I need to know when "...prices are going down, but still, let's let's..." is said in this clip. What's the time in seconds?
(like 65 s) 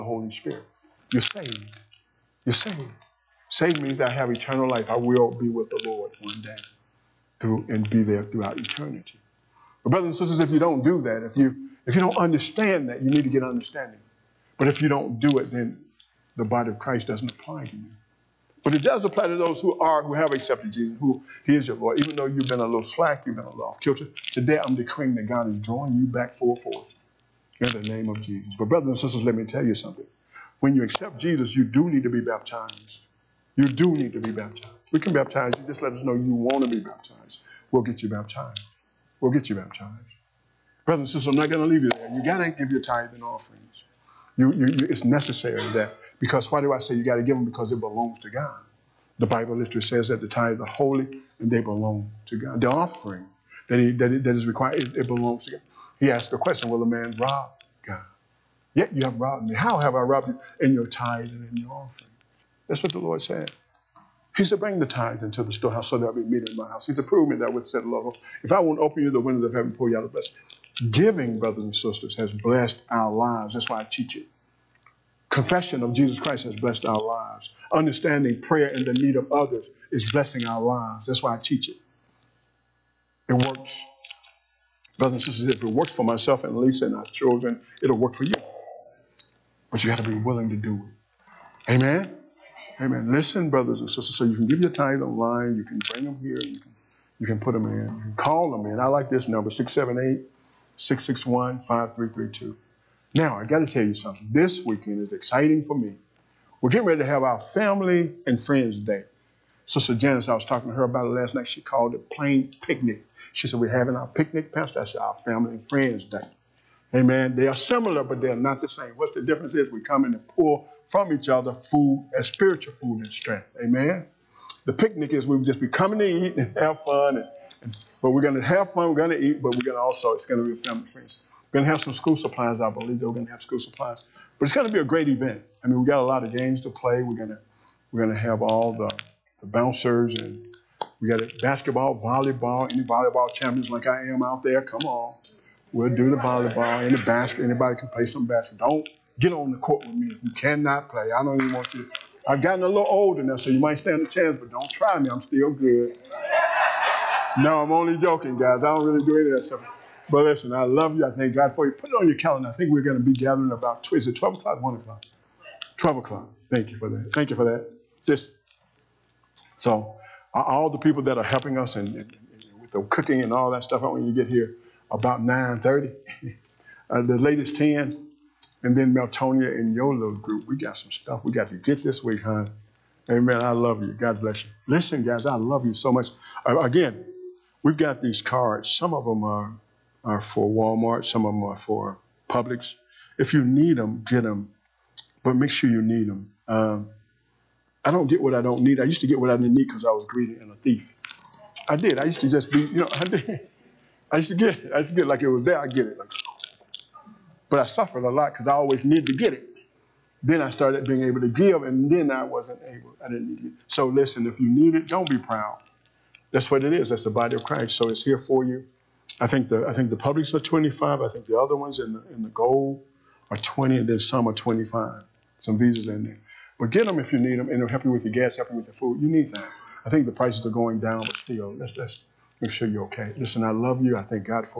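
230 s.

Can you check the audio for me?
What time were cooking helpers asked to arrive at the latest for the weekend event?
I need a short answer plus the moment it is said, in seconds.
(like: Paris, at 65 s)
10, at 177 s.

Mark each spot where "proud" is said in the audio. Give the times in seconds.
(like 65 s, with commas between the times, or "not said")
215 s.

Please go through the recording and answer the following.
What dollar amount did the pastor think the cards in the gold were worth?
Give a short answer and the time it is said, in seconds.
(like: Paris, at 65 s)
20, at 223 s.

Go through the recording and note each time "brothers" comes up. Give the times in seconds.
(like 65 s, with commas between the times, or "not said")
9 s, 28 s, 40 s, 71 s, 84 s, 93 s.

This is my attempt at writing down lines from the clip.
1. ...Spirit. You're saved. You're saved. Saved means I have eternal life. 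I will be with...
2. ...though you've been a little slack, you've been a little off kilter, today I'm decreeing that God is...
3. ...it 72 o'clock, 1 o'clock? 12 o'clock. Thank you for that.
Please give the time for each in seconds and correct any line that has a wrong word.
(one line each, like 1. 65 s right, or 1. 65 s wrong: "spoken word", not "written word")
1. 0 s right
2. 22 s right
3. 164 s wrong: "12", not "72".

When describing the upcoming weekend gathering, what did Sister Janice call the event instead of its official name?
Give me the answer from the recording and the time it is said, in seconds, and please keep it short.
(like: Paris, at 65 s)
plain picnic, at 112 s.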